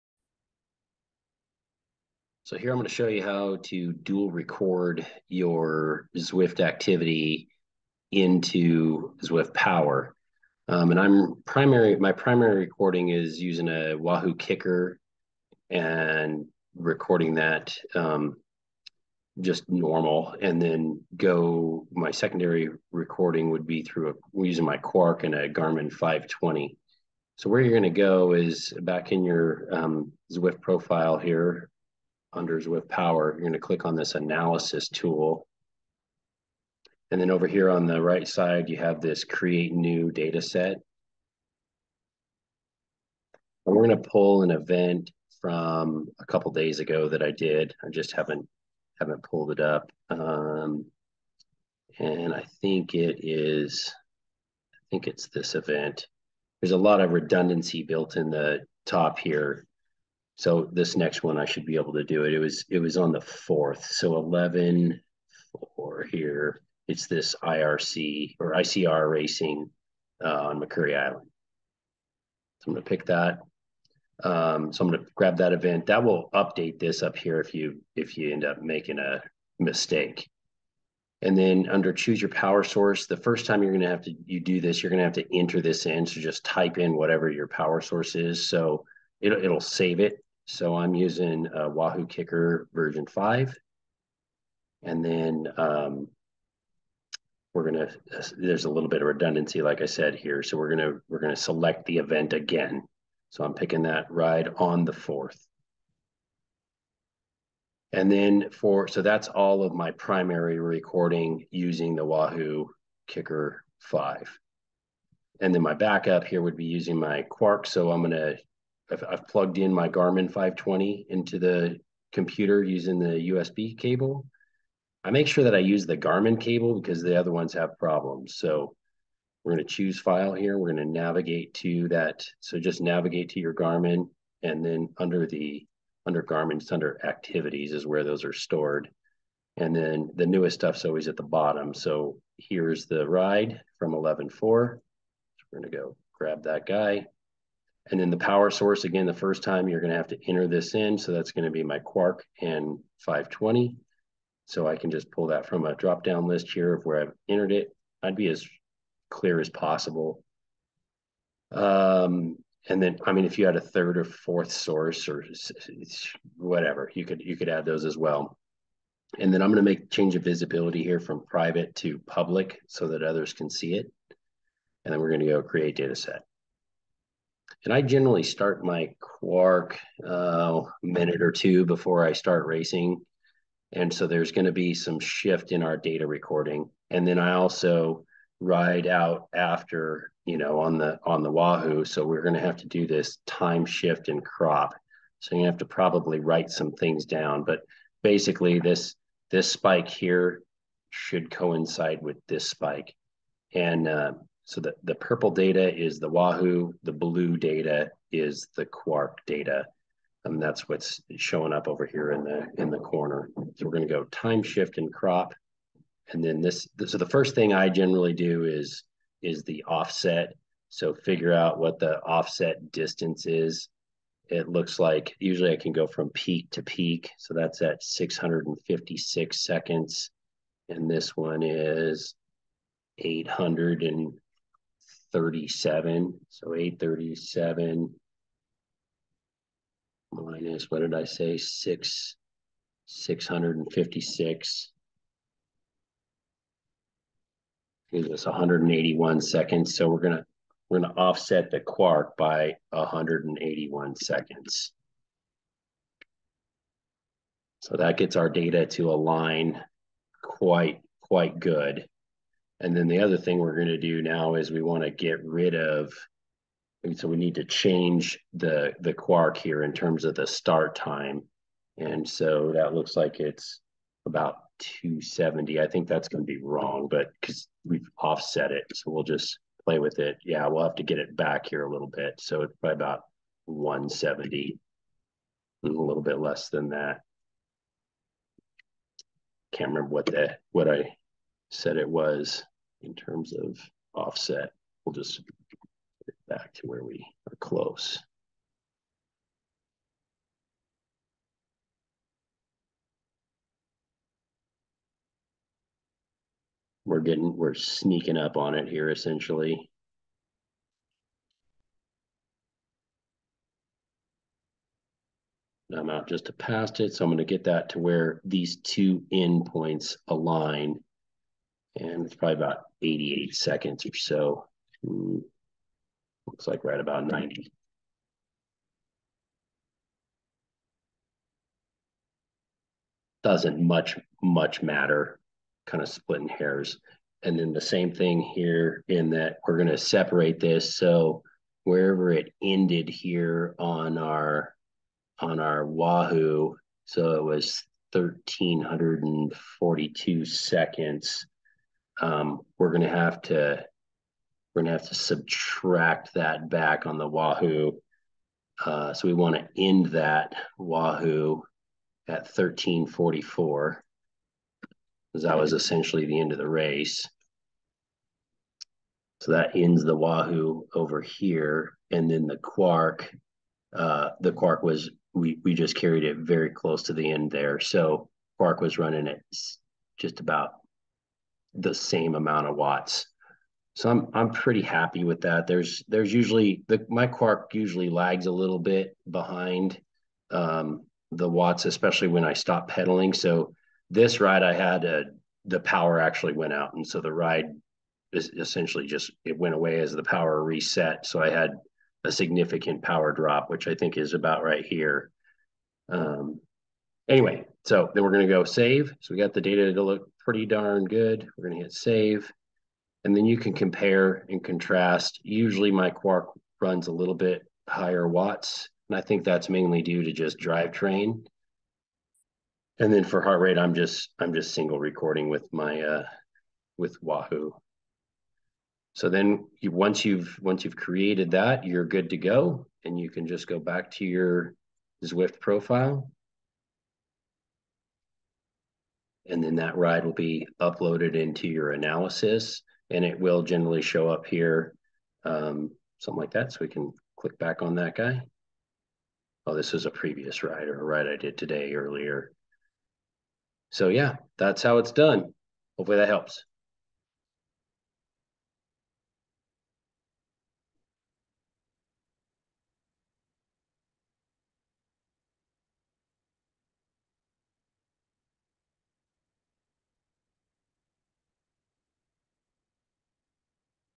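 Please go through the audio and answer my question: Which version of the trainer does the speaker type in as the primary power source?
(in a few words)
version 5.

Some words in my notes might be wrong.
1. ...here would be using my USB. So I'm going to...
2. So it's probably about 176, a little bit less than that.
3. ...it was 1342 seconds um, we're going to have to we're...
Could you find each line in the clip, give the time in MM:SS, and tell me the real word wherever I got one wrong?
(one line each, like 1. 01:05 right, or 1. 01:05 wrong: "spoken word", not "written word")
1. 01:56 wrong: "Quarq", not "USB"
2. 04:42 wrong: "170", not "176"
3. 05:47 right.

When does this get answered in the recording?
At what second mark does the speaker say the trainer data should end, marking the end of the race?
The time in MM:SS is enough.
06:02.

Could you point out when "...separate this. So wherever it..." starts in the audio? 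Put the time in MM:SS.
05:39.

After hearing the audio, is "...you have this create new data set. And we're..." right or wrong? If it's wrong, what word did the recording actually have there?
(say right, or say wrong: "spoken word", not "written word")
right.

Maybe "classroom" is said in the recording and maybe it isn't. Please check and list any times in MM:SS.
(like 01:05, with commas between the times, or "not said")
not said.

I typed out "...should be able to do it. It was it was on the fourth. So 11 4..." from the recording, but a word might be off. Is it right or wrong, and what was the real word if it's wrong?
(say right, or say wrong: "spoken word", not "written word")
right.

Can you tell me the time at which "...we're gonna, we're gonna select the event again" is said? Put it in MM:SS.
01:40.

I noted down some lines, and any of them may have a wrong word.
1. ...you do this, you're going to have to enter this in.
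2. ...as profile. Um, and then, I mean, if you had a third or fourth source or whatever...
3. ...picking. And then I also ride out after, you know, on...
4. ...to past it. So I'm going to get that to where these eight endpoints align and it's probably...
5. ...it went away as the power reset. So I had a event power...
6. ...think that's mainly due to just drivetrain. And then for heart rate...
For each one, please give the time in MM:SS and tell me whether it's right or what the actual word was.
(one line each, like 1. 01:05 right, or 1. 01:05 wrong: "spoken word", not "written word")
1. 01:24 right
2. 02:39 wrong: "possible", not "profile"
3. 03:06 wrong: "recording", not "picking"
4. 05:16 wrong: "two", not "eight"
5. 06:39 wrong: "significant", not "event"
6. 06:59 right.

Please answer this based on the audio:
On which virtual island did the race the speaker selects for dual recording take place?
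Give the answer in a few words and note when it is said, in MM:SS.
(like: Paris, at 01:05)
Makuri Island, at 01:10.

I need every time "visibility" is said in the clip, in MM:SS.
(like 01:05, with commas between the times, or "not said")
02:50.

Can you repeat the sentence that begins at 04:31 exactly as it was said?
And so that looks like it's about 270.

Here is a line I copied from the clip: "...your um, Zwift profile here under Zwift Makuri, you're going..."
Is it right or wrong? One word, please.
wrong.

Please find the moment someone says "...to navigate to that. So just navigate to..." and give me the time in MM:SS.
02:10.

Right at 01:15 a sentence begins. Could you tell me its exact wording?
That will update this up here if you if you end up making a mistake.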